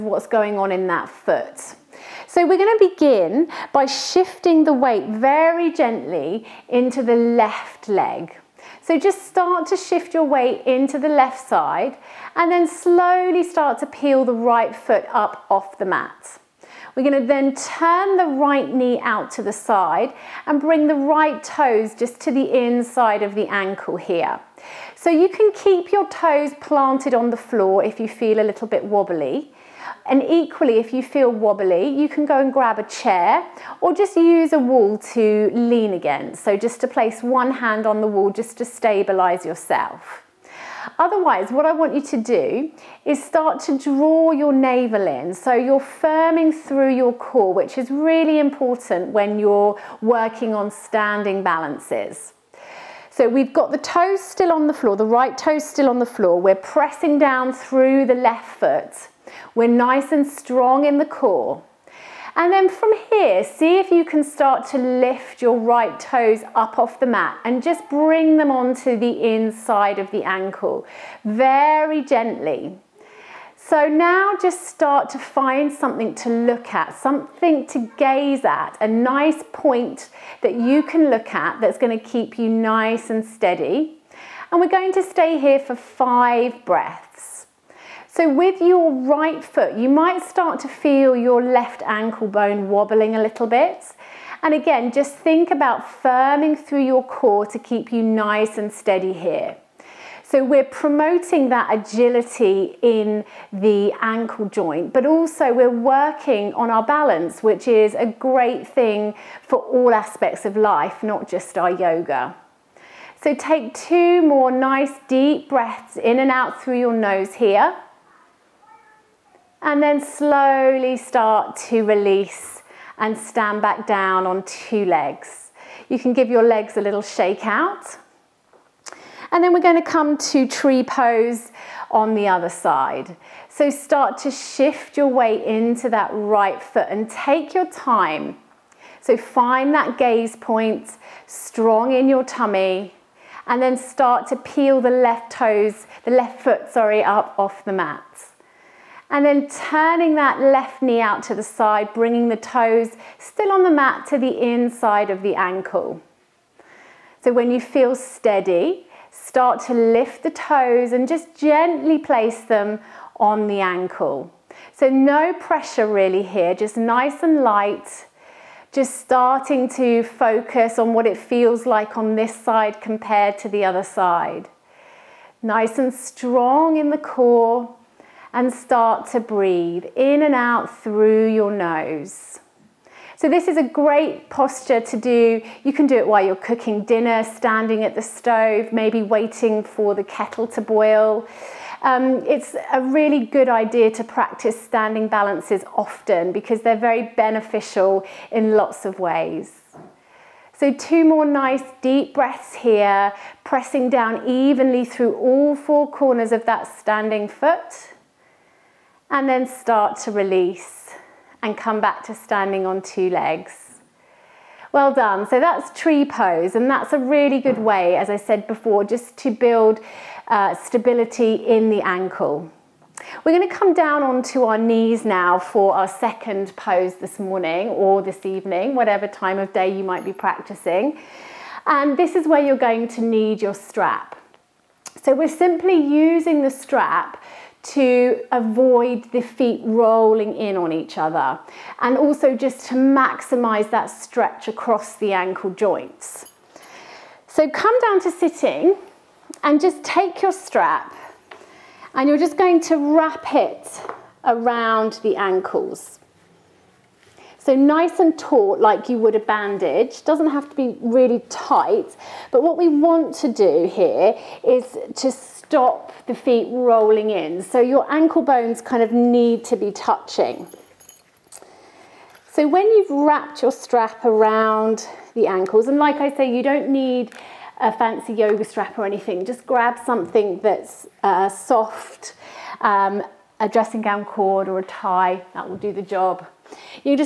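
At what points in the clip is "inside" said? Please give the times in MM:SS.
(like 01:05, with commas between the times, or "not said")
00:22, 01:09, 02:34.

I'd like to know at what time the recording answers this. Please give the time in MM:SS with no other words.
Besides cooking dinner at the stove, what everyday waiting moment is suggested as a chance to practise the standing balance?
03:10.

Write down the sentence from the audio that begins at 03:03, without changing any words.
So this is a great posture to do.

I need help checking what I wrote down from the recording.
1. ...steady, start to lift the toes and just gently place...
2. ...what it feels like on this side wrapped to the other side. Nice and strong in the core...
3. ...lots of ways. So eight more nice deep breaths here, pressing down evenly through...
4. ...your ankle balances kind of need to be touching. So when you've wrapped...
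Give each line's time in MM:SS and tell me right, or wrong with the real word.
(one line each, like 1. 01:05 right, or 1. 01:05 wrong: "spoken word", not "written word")
1. 02:37 right
2. 02:50 wrong: "compared", not "wrapped"
3. 03:18 wrong: "two", not "eight"
4. 04:27 wrong: "bones", not "balances".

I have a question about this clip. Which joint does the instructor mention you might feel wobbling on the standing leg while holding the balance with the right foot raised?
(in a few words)
left ankle bone.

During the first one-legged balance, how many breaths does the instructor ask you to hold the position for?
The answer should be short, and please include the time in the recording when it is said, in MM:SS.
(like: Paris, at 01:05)
5, at 01:25.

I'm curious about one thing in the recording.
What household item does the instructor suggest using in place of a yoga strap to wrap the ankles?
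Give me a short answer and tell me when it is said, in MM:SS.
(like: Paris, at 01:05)
dressing gown cord, at 04:43.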